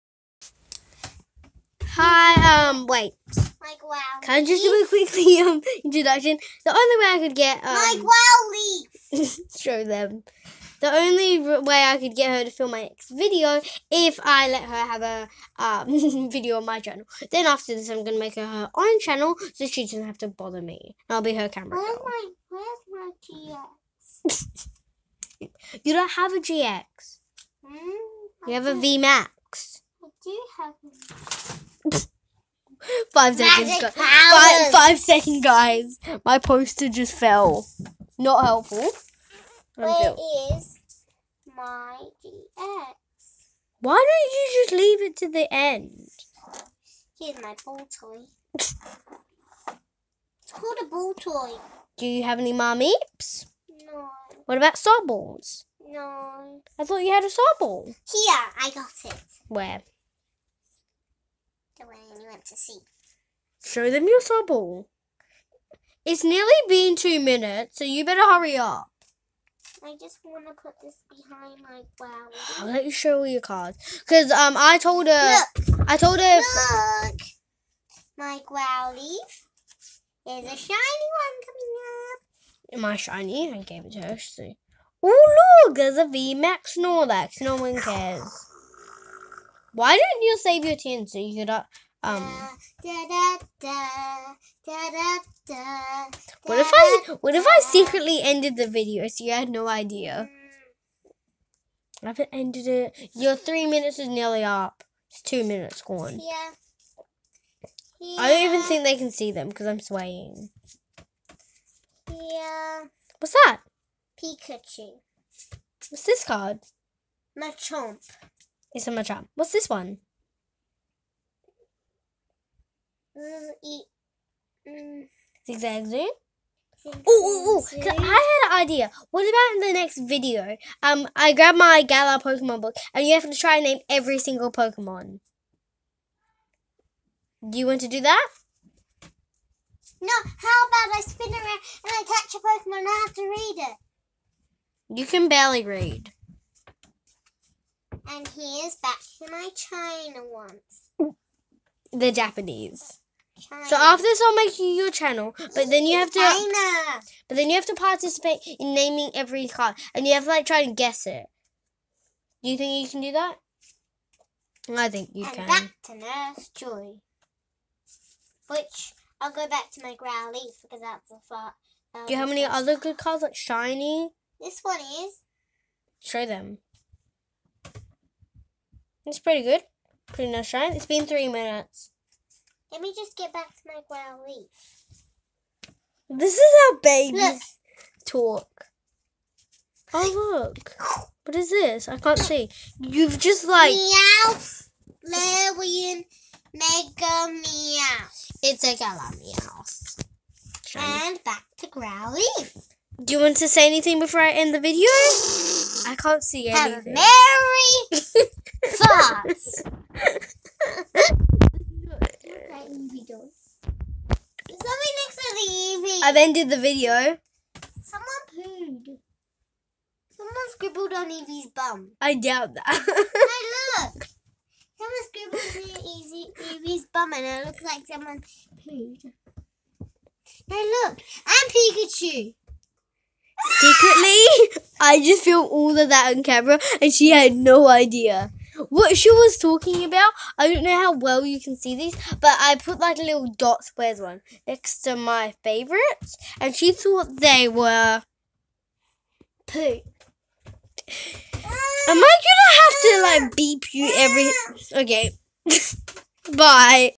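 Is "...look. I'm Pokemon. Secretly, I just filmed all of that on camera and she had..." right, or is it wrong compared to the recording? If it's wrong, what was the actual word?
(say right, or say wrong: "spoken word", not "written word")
wrong: "Pikachu", not "Pokemon".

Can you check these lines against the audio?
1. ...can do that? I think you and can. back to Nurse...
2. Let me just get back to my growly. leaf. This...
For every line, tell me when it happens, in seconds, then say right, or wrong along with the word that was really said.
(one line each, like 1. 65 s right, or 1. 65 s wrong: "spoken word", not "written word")
1. 162 s right
2. 182 s right.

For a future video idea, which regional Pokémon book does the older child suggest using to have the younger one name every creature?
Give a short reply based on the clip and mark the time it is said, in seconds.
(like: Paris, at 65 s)
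Galar Pokemon book, at 131 s.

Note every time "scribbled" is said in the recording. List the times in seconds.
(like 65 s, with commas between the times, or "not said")
220 s, 225 s.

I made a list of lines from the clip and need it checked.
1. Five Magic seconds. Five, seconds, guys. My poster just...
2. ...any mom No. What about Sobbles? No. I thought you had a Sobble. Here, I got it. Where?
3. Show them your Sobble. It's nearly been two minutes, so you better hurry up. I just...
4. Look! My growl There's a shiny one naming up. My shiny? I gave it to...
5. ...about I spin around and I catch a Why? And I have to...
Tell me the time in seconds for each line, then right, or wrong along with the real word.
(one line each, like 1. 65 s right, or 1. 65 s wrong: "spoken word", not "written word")
1. 33 s right
2. 52 s right
3. 63 s right
4. 76 s wrong: "coming", not "naming"
5. 140 s wrong: "Pokemon", not "Why".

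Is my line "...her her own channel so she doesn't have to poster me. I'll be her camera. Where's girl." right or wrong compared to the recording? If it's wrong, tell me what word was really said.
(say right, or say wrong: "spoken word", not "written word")
wrong: "bother", not "poster".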